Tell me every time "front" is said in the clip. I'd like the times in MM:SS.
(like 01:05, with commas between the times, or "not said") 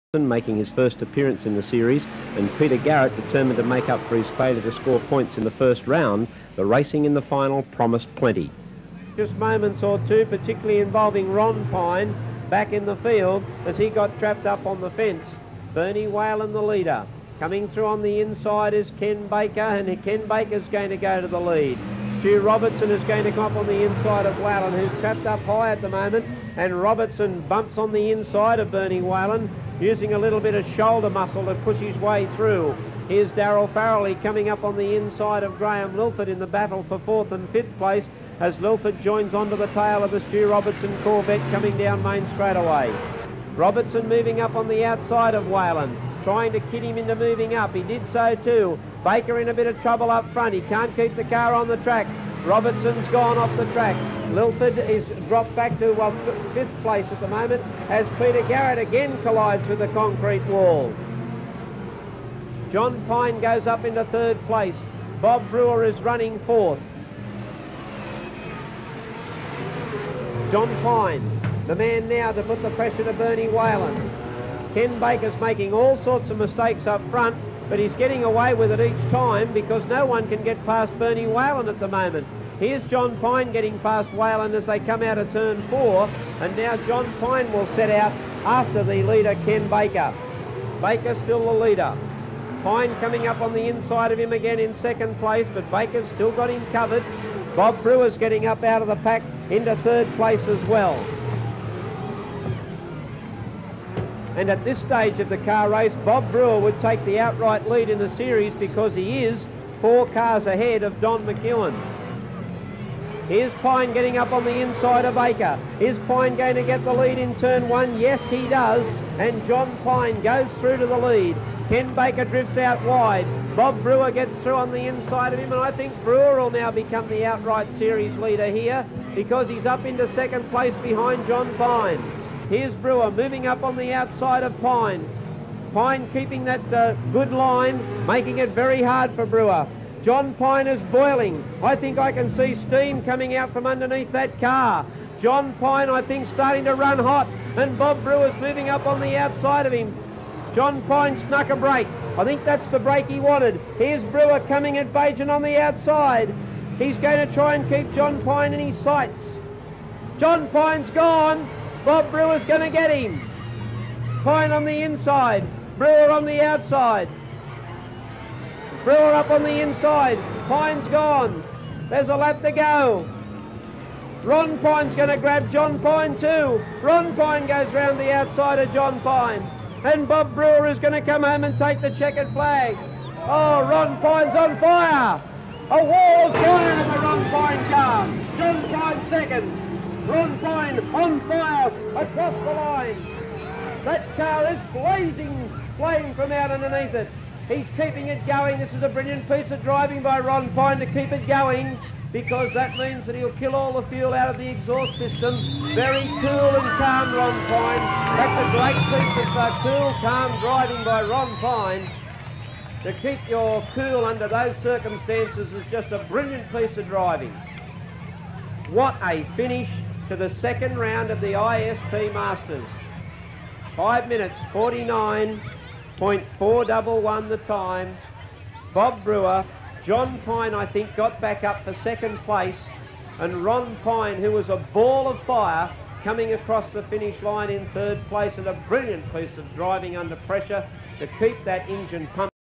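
00:50, 01:17.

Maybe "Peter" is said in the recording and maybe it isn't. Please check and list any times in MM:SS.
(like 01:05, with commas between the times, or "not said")
00:02, 00:58.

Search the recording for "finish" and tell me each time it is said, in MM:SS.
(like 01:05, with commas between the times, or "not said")
03:39, 03:56.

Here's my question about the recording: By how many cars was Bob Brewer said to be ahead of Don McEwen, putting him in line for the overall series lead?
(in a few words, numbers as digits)
4.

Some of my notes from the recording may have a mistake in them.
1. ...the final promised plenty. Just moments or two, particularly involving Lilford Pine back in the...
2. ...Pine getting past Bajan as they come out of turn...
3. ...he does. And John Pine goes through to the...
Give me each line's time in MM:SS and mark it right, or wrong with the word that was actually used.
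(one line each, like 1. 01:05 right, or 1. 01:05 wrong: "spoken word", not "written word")
1. 00:07 wrong: "Ron", not "Lilford"
2. 01:23 wrong: "Whalen", not "Bajan"
3. 01:58 right.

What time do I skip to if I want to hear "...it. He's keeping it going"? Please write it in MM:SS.
03:16.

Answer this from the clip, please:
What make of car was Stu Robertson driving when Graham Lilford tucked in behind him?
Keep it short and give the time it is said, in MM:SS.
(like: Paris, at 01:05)
Corvette, at 00:41.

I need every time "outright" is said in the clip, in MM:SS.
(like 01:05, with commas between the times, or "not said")
01:47, 02:07.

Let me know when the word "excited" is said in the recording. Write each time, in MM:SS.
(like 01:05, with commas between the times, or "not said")
not said.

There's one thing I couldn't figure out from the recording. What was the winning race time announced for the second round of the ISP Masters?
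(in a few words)
5 minutes 49.411.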